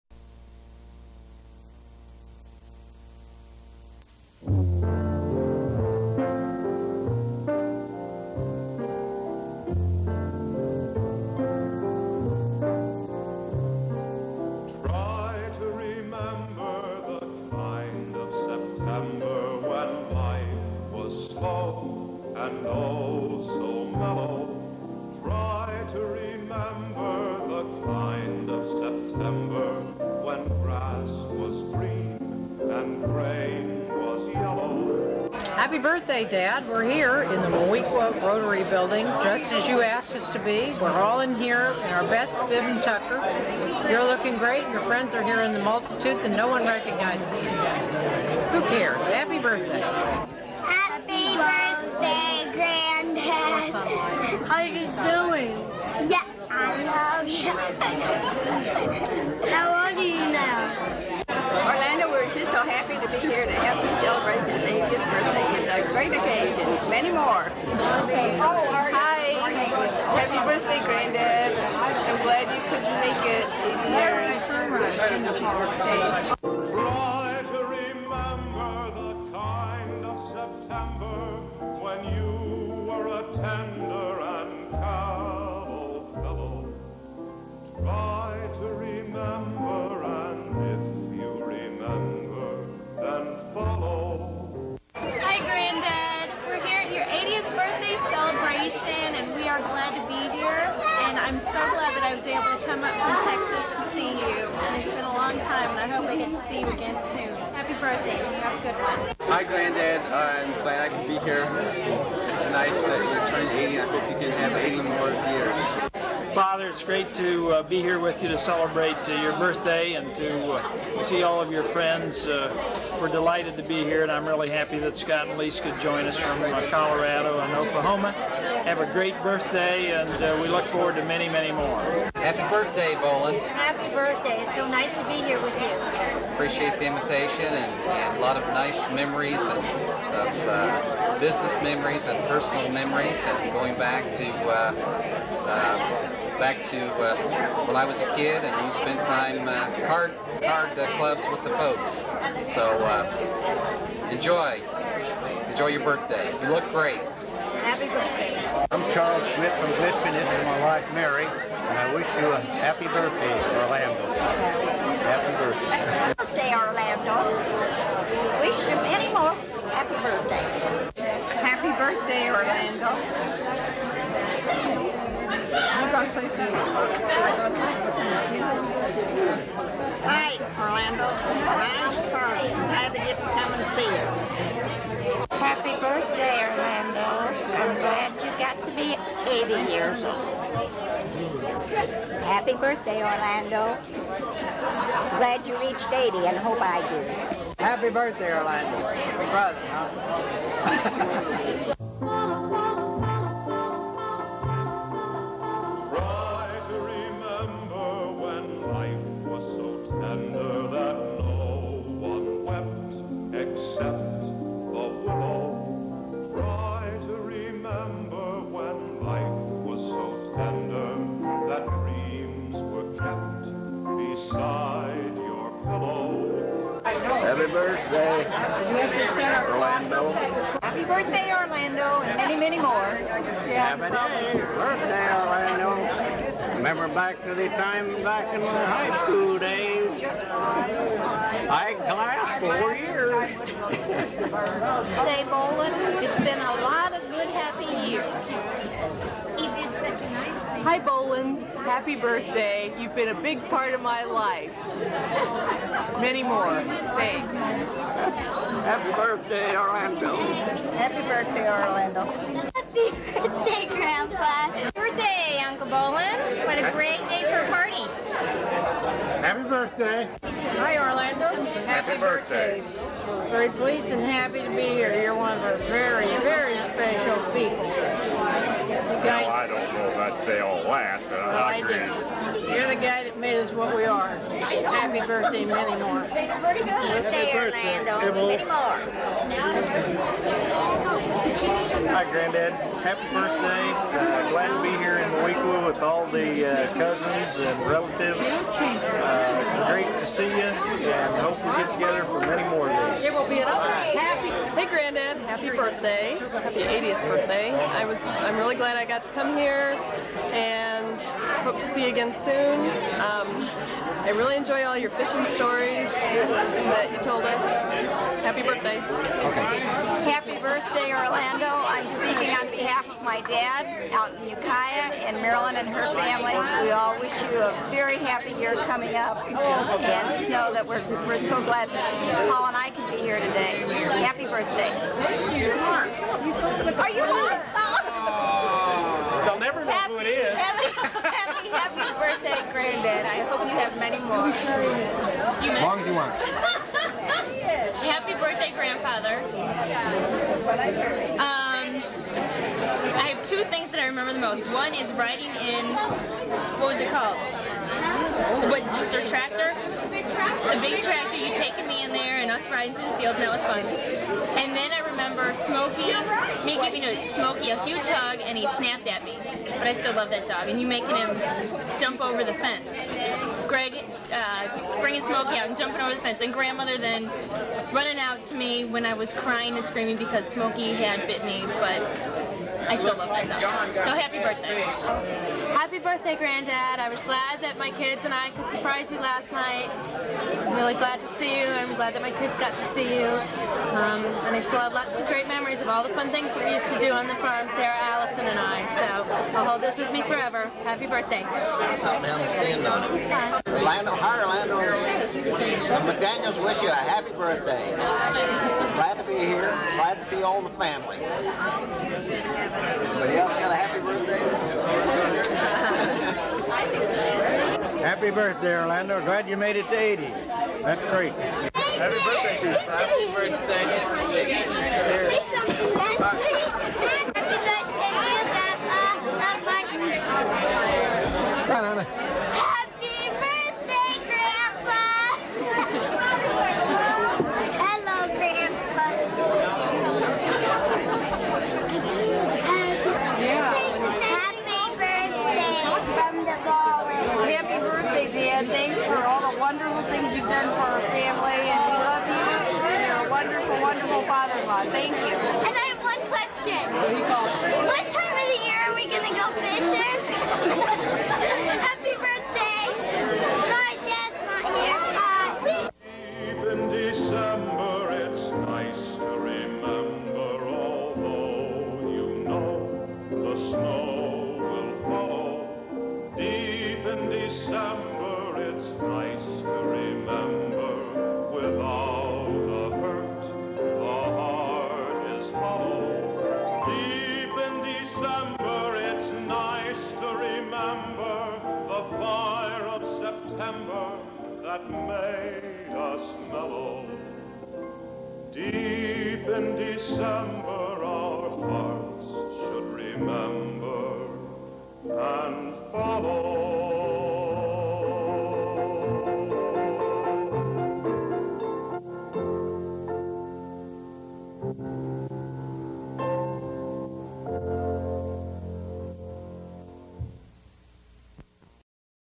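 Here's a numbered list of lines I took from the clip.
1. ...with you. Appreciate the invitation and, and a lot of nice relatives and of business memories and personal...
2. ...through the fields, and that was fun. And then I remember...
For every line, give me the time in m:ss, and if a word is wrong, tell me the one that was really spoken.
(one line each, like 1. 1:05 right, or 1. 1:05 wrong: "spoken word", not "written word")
1. 2:15 wrong: "memories", not "relatives"
2. 6:02 right.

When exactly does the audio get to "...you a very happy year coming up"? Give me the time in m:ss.
5:27.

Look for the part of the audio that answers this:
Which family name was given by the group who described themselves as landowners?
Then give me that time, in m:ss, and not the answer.
6:44.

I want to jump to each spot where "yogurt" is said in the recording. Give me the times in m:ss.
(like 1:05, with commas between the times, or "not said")
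not said.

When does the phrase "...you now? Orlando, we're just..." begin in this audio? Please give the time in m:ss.
1:00.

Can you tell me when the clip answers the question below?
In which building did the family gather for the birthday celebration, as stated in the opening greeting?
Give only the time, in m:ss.
0:37.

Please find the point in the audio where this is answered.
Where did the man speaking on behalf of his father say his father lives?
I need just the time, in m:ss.
5:24.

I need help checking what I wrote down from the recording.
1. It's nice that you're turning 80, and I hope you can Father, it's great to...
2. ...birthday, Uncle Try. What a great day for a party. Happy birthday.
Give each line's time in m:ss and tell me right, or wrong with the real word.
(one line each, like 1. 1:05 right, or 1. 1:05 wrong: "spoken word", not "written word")
1. 1:52 right
2. 4:24 wrong: "Bohlen", not "Try".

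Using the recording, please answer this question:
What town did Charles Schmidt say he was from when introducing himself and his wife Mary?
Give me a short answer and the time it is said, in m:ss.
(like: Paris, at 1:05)
Lisbon, at 2:39.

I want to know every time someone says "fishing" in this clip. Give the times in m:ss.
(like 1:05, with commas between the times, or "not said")
5:14, 7:39.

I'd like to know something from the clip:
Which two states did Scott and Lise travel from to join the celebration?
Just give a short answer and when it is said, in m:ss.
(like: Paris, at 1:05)
Colorado and Oklahoma, at 2:06.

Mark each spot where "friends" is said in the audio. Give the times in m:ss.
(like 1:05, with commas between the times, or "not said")
0:44, 2:01.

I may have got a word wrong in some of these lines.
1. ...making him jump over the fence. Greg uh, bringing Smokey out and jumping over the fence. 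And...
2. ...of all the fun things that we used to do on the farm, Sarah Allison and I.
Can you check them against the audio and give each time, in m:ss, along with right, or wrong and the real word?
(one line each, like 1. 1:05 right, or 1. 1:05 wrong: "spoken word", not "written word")
1. 6:10 right
2. 6:35 right.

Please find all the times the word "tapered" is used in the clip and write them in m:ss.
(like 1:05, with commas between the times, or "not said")
not said.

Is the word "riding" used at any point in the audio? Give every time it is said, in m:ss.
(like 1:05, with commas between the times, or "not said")
5:54, 6:02.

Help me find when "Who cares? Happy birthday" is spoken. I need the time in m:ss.
0:48.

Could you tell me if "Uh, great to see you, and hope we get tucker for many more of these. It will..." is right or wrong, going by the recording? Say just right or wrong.
wrong.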